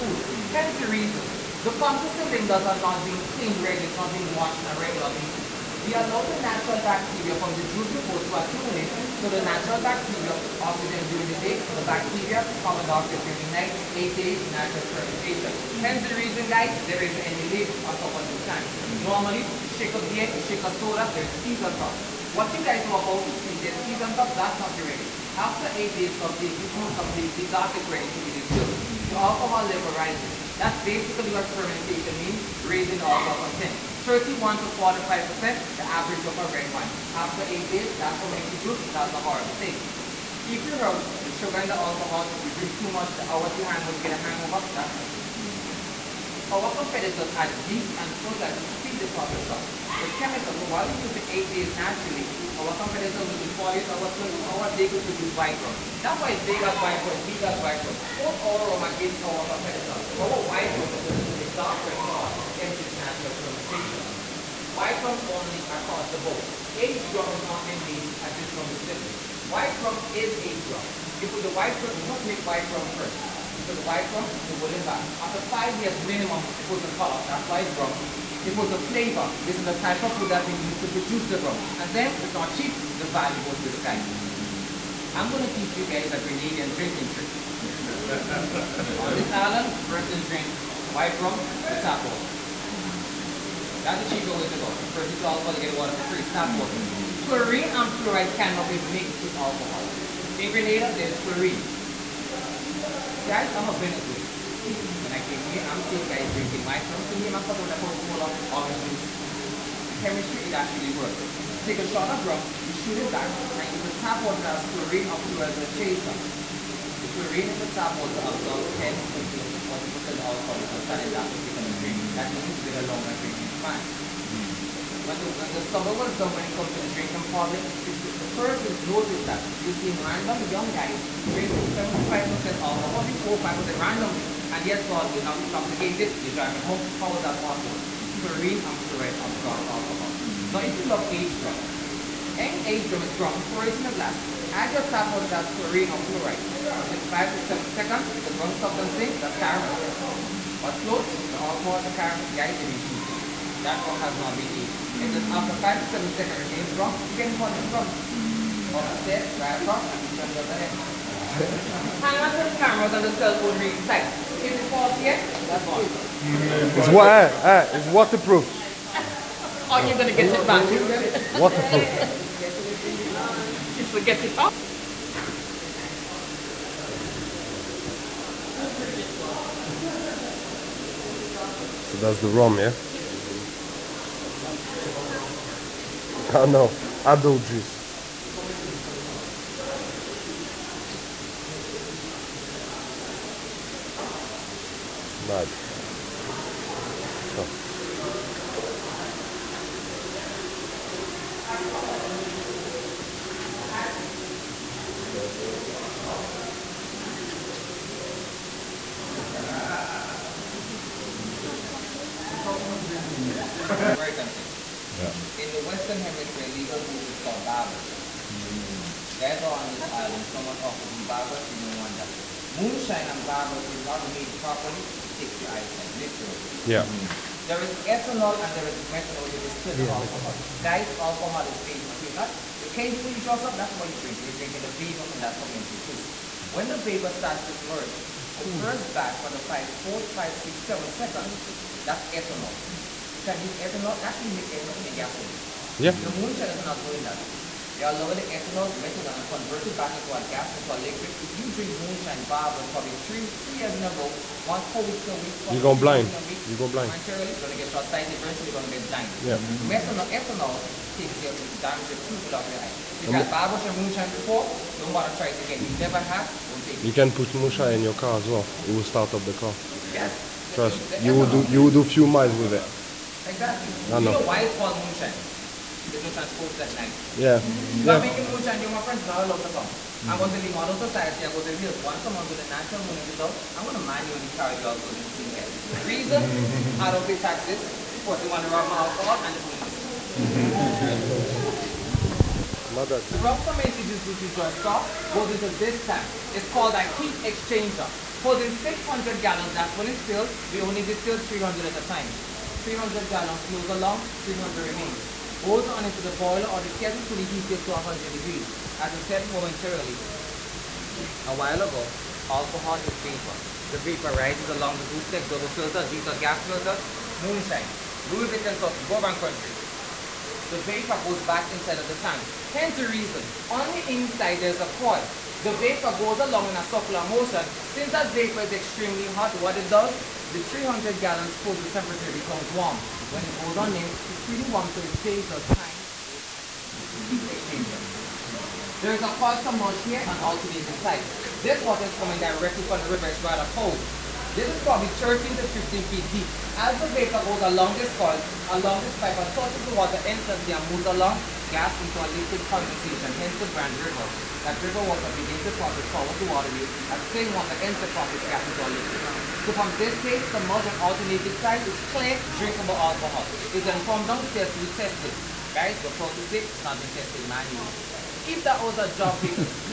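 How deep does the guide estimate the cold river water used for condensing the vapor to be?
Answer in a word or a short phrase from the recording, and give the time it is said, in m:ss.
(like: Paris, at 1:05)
13 to 15 feet, at 5:44.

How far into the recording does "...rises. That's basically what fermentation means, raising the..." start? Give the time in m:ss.
0:29.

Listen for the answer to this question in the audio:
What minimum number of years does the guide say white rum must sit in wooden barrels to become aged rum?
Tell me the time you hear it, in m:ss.
1:15.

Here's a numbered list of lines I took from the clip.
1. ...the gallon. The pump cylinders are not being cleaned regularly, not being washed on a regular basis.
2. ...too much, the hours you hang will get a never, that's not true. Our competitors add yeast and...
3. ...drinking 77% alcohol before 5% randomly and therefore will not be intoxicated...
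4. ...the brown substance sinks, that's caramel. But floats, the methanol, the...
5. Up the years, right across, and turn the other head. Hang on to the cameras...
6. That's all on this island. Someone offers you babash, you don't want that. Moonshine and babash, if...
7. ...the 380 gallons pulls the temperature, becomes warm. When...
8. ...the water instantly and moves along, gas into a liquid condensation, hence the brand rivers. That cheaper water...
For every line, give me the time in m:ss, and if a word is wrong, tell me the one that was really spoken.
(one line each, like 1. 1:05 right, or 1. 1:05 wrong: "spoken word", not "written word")
1. 0:00 wrong: "reason", not "gallon"
2. 0:42 wrong: "hangover", not "never"
3. 2:11 wrong: "75", not "77"
4. 2:28 wrong: "alcohol", not "methanol"
5. 2:38 wrong: "stairs", not "years"
6. 3:39 right
7. 5:30 wrong: "300", not "380"
8. 5:49 wrong: "river", not "cheaper".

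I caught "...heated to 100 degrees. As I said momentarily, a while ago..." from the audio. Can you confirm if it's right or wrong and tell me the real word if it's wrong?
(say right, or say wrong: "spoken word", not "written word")
right.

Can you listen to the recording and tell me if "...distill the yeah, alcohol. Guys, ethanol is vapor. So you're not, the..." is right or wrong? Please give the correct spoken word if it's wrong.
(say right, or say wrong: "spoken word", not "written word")
wrong: "alcohol", not "ethanol".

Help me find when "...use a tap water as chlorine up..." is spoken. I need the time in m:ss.
1:53.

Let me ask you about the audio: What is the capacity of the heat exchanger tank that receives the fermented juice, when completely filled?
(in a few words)
600 gallons.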